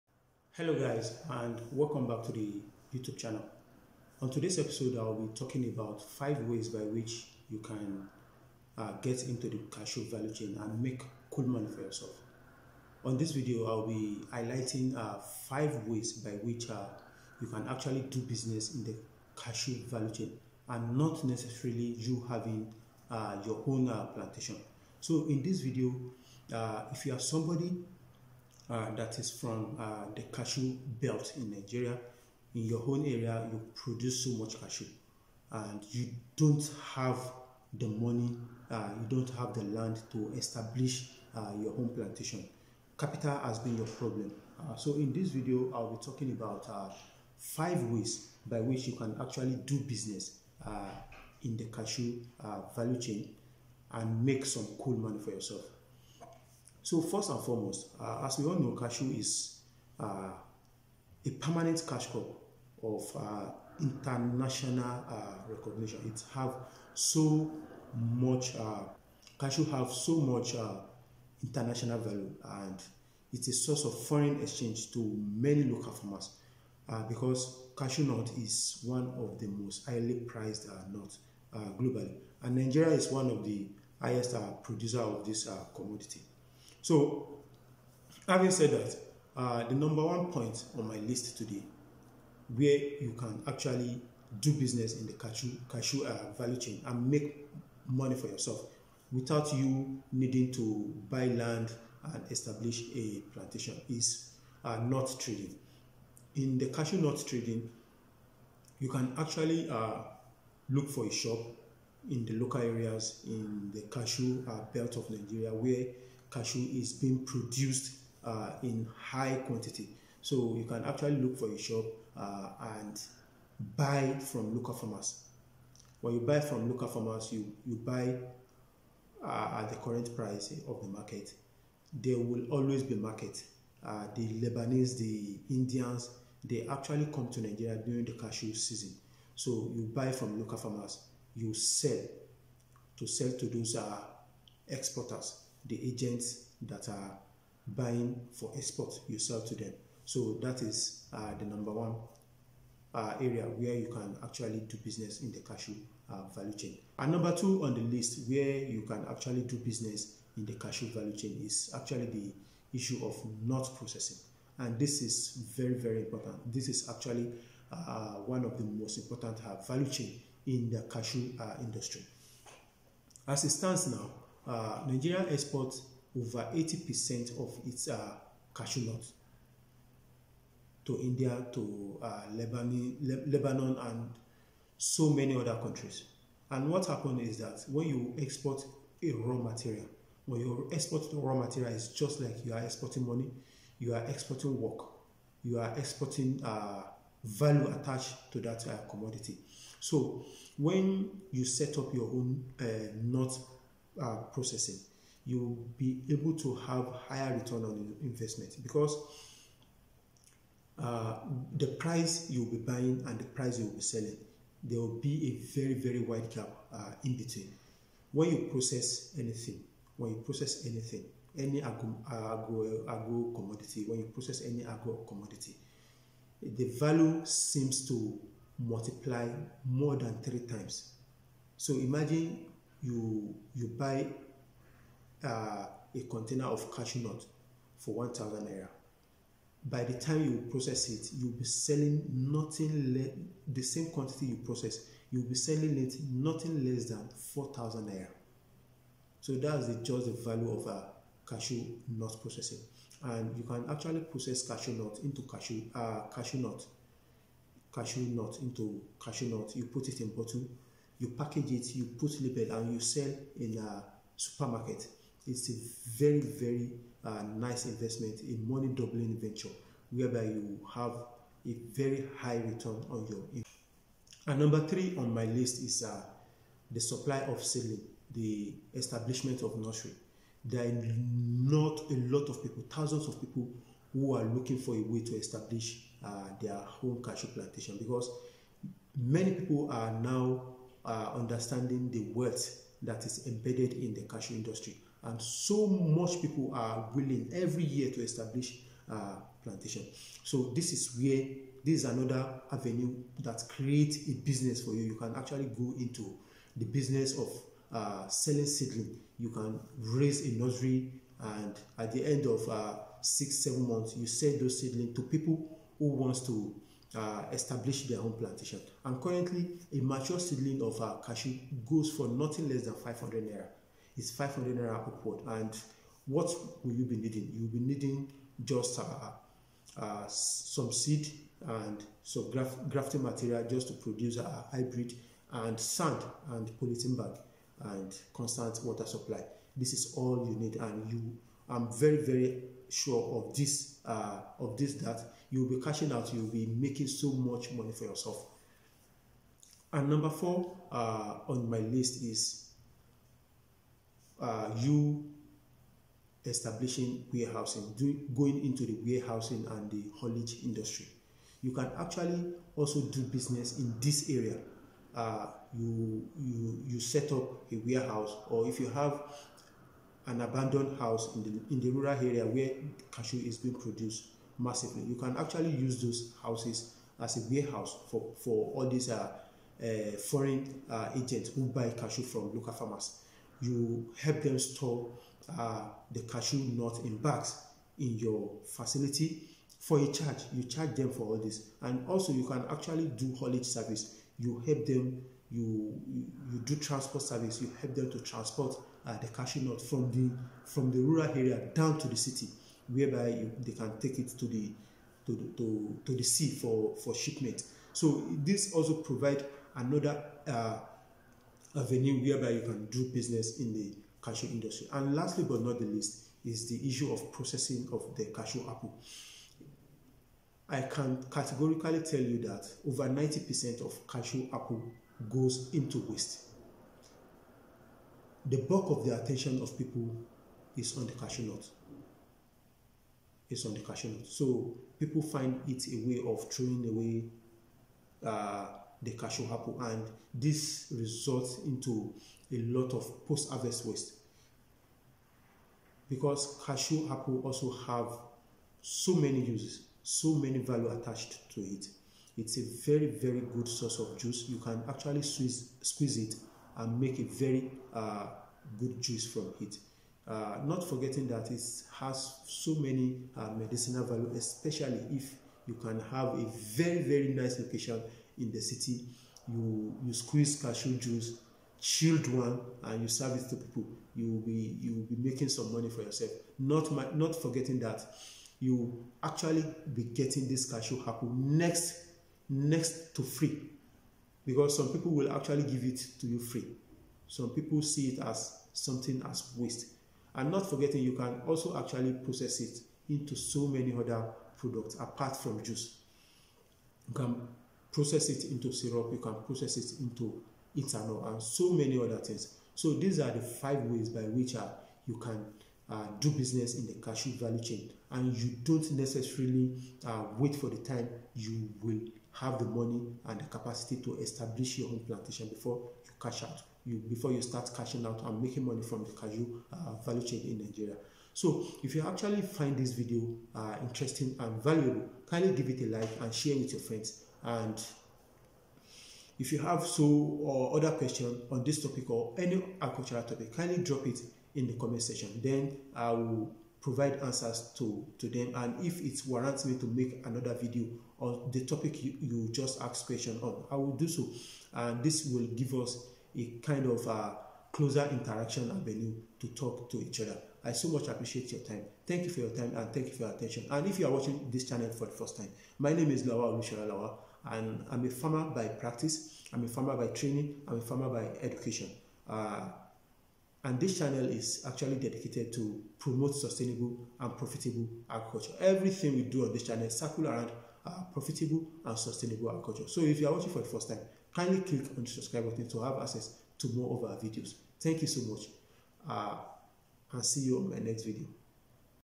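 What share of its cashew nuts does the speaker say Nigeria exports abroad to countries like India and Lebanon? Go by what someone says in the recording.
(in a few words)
over 80%.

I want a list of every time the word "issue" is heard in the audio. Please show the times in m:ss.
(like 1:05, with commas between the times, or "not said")
2:42, 6:56.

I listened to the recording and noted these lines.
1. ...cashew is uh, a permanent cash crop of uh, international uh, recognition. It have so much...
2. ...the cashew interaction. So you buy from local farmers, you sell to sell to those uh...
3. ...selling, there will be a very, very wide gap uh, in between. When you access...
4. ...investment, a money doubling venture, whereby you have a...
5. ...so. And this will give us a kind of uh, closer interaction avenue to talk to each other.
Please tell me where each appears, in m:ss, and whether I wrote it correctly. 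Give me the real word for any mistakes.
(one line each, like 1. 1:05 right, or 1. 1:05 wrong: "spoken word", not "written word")
1. 0:58 right
2. 2:18 wrong: "season", not "interaction"
3. 3:33 wrong: "process", not "access"
4. 4:27 right
5. 9:03 right.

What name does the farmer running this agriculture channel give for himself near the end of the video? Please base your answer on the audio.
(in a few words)
Lawa Olushola Lawa.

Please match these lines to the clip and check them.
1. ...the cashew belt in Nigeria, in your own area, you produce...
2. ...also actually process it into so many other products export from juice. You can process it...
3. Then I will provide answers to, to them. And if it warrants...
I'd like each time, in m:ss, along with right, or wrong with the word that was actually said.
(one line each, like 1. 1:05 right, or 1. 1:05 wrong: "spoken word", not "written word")
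1. 0:30 right
2. 8:11 wrong: "apart", not "export"
3. 8:55 right.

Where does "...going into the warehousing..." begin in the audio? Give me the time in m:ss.
5:58.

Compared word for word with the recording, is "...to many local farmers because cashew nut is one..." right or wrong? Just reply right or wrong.
right.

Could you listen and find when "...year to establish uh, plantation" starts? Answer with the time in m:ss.
4:57.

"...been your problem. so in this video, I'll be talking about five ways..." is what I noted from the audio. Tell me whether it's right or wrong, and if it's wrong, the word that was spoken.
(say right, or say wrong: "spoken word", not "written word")
right.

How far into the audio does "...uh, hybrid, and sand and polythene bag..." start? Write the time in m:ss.
5:34.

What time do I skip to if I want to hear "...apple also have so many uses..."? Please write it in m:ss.
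7:26.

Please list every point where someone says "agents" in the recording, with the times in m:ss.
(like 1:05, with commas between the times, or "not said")
2:25, 6:20.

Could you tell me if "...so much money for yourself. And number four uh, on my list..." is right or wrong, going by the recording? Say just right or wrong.
right.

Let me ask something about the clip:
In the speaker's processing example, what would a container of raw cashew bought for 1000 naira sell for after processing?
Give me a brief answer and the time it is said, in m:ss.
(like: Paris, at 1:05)
4000 naira, at 4:07.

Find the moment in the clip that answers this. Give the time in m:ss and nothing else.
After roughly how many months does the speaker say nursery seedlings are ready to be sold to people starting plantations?
5:13.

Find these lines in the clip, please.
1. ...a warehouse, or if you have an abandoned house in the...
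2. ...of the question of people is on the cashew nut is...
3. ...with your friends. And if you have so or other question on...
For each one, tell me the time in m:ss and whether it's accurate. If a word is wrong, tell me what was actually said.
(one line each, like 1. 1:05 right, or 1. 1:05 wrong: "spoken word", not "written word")
1. 6:07 right
2. 7:08 wrong: "attention", not "question"
3. 8:46 right.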